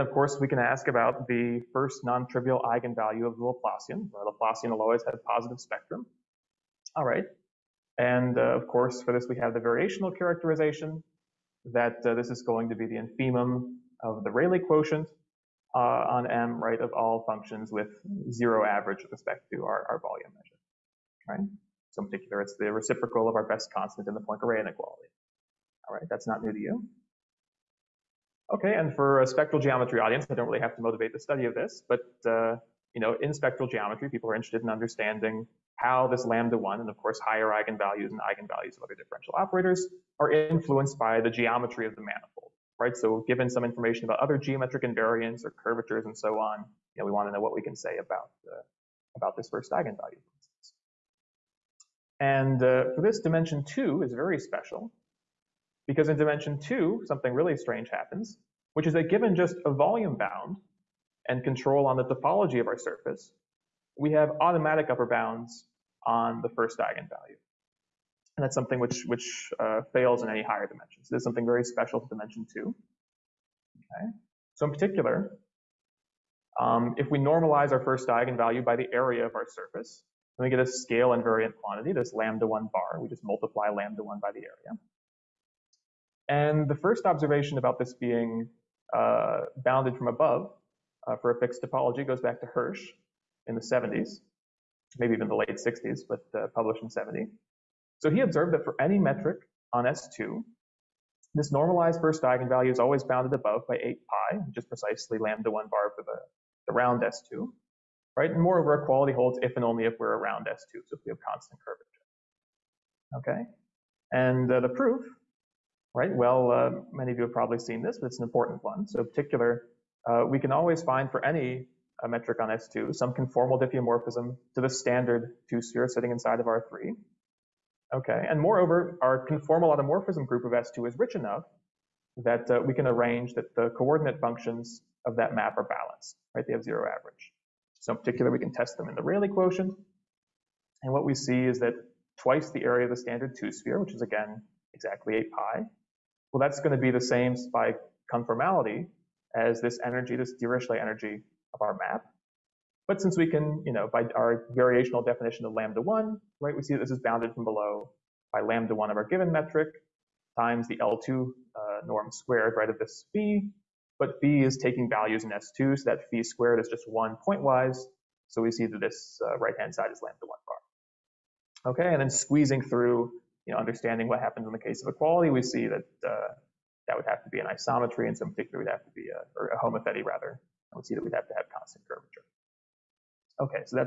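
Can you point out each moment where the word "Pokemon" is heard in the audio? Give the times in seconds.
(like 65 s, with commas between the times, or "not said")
not said.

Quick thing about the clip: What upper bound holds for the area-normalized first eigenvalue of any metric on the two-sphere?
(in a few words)
8 pi.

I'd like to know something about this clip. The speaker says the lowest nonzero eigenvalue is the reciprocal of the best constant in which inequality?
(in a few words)
Poincare inequality.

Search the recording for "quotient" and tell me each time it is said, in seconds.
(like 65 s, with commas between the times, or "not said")
14 s, 139 s.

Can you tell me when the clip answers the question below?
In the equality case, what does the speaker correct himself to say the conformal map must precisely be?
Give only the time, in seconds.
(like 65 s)
179 s.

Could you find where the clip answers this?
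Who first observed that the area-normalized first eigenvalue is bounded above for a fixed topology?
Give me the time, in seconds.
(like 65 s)
92 s.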